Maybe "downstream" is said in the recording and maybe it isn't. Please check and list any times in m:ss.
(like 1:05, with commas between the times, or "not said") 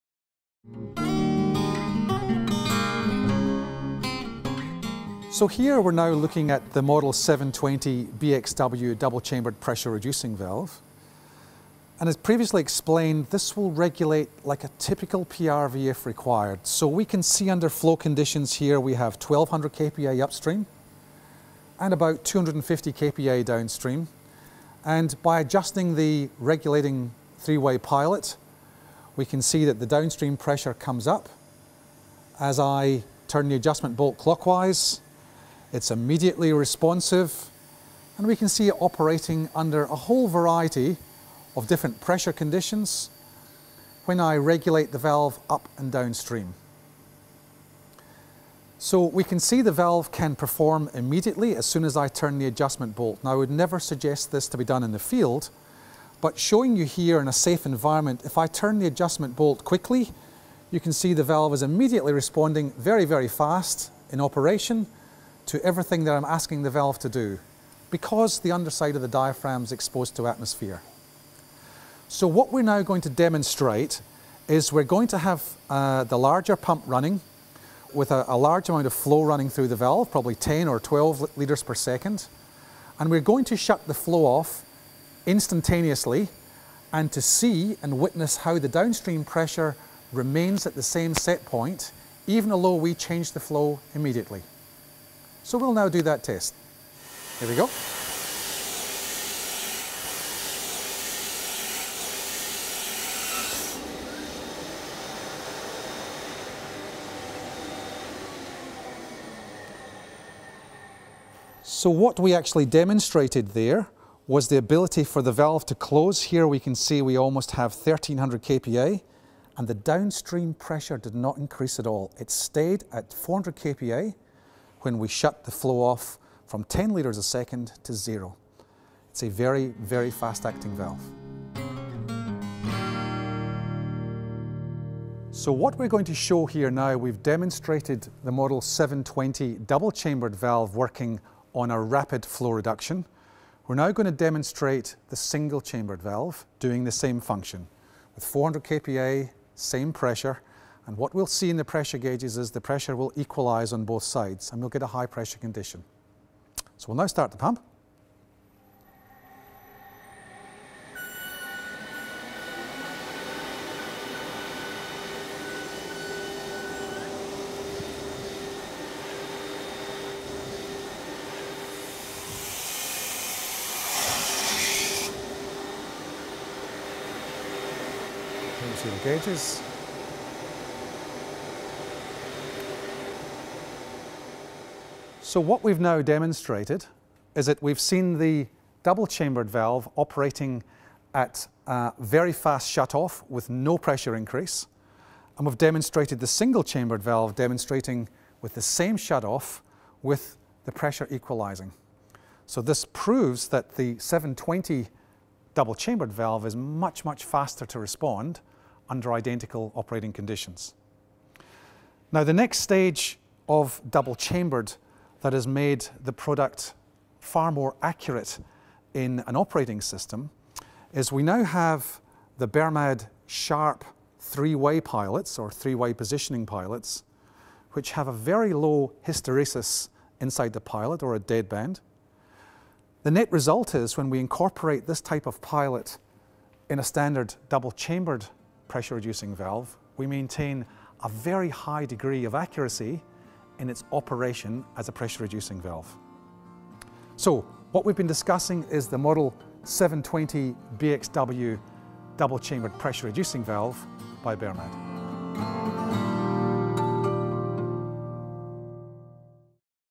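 0:23, 0:29, 0:45, 1:28, 1:59.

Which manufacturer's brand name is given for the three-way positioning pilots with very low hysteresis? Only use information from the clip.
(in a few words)
Bermad Sharp.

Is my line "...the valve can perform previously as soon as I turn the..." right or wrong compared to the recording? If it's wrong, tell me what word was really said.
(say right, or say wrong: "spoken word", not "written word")
wrong: "immediately", not "previously".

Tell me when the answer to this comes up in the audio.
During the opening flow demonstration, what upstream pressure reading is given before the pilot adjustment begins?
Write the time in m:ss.
0:19.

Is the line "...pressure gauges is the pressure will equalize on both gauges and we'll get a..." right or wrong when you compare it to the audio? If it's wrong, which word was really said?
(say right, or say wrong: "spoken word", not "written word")
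wrong: "sides", not "gauges".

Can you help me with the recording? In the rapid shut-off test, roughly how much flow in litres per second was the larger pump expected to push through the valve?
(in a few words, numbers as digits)
10 or 12 litres per second.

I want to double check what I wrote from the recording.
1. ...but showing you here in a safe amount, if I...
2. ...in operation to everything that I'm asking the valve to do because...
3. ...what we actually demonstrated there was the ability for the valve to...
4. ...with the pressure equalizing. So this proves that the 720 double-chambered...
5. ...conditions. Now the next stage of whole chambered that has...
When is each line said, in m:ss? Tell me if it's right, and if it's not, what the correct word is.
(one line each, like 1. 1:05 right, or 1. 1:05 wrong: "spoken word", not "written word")
1. 0:56 wrong: "environment", not "amount"
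2. 1:04 right
3. 1:51 right
4. 3:20 right
5. 3:30 wrong: "double", not "whole".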